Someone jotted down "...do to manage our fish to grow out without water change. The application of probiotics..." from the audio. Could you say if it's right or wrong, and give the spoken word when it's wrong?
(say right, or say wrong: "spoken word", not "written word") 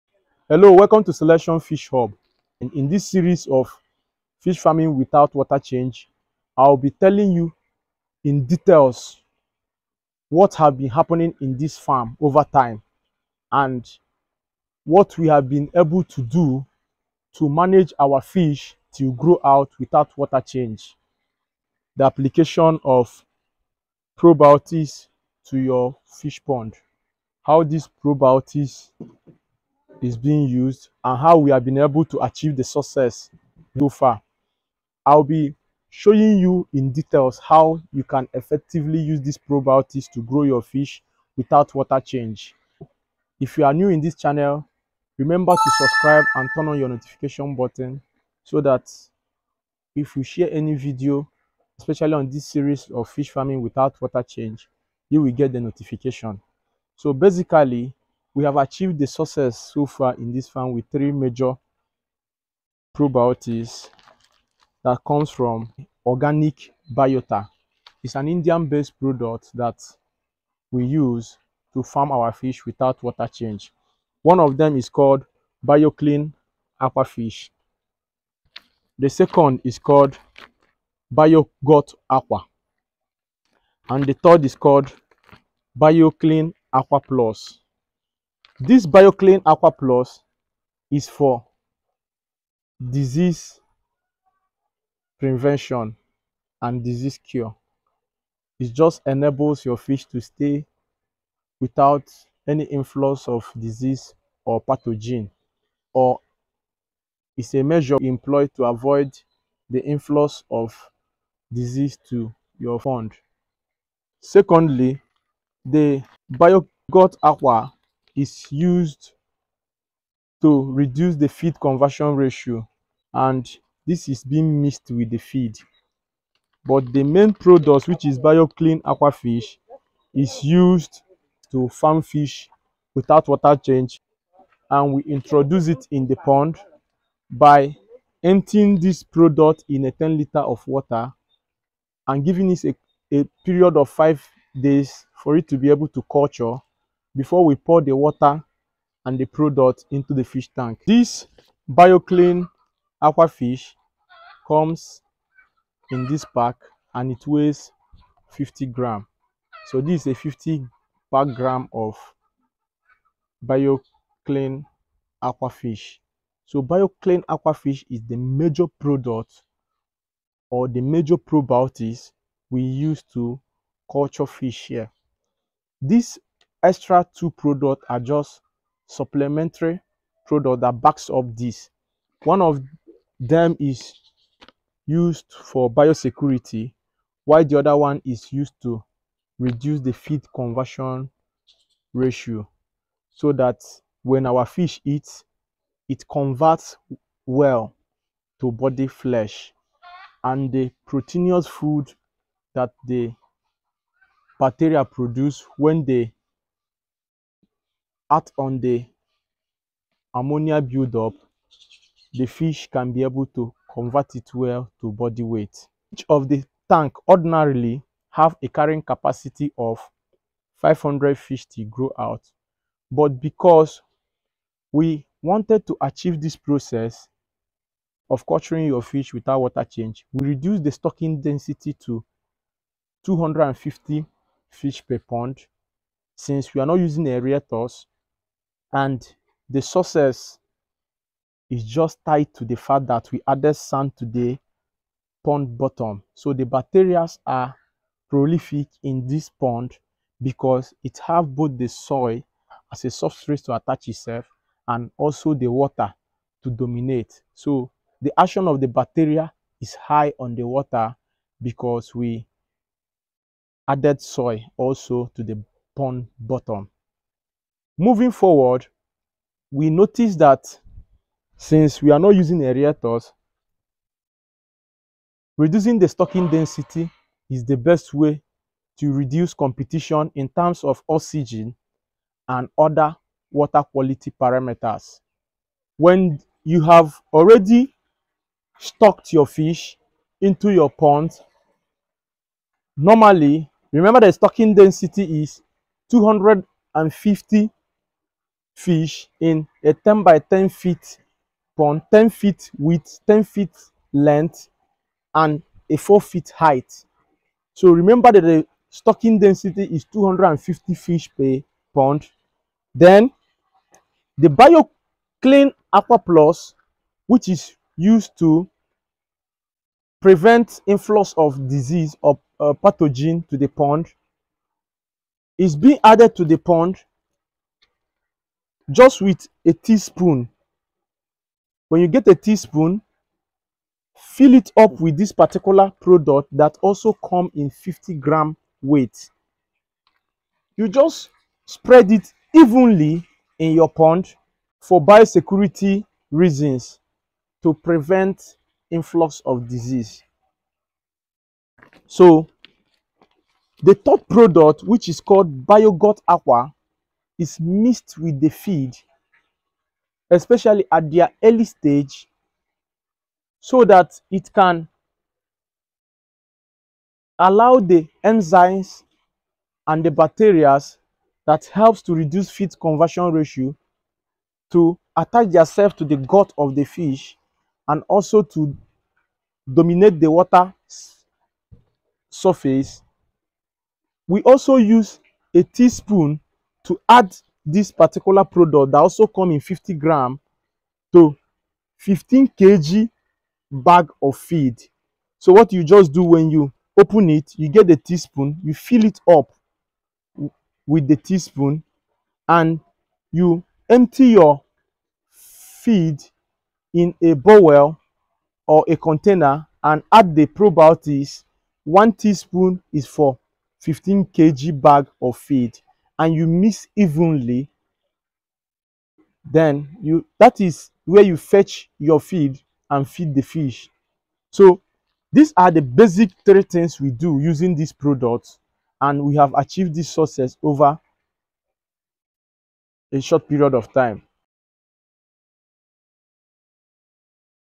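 right.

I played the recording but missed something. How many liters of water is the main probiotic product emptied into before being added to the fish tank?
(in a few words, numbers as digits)
10 liters.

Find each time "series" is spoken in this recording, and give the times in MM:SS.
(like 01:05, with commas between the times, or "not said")
00:03, 00:52.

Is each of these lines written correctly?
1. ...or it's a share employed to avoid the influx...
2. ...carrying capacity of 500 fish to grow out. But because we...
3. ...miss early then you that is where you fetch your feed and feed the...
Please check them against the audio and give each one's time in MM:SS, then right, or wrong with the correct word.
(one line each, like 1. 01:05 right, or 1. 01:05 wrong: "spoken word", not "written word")
1. 01:45 wrong: "measure", not "share"
2. 03:38 right
3. 06:56 wrong: "evenly", not "early".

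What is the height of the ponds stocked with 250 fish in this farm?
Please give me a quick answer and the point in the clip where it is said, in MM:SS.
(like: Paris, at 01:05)
4 feet, at 05:05.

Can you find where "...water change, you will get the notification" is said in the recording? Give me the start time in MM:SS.
00:54.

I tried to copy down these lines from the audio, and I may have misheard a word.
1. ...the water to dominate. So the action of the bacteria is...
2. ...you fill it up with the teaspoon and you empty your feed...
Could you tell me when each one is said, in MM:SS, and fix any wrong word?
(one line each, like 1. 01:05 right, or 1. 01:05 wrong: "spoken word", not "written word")
1. 04:15 right
2. 06:38 right.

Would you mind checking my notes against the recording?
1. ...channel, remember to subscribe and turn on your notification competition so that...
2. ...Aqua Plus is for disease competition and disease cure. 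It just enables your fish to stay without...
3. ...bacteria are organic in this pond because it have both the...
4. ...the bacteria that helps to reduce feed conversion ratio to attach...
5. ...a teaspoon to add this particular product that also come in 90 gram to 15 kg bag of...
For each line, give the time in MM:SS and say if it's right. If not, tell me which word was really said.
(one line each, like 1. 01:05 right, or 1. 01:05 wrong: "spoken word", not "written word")
1. 00:44 wrong: "button", not "competition"
2. 01:29 wrong: "prevention", not "competition"
3. 04:06 wrong: "prolific", not "organic"
4. 06:09 right
5. 06:25 wrong: "50", not "90".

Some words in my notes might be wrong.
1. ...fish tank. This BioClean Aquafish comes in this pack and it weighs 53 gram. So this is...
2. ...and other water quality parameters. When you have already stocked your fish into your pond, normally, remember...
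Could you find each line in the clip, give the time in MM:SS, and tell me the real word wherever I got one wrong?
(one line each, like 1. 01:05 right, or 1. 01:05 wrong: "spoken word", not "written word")
1. 02:30 wrong: "50", not "53"
2. 04:42 right.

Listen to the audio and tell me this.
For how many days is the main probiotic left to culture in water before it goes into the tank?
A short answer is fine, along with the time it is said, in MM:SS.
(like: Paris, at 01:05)
5 days, at 02:23.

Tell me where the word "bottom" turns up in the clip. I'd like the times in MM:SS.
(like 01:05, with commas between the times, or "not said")
04:05, 04:26.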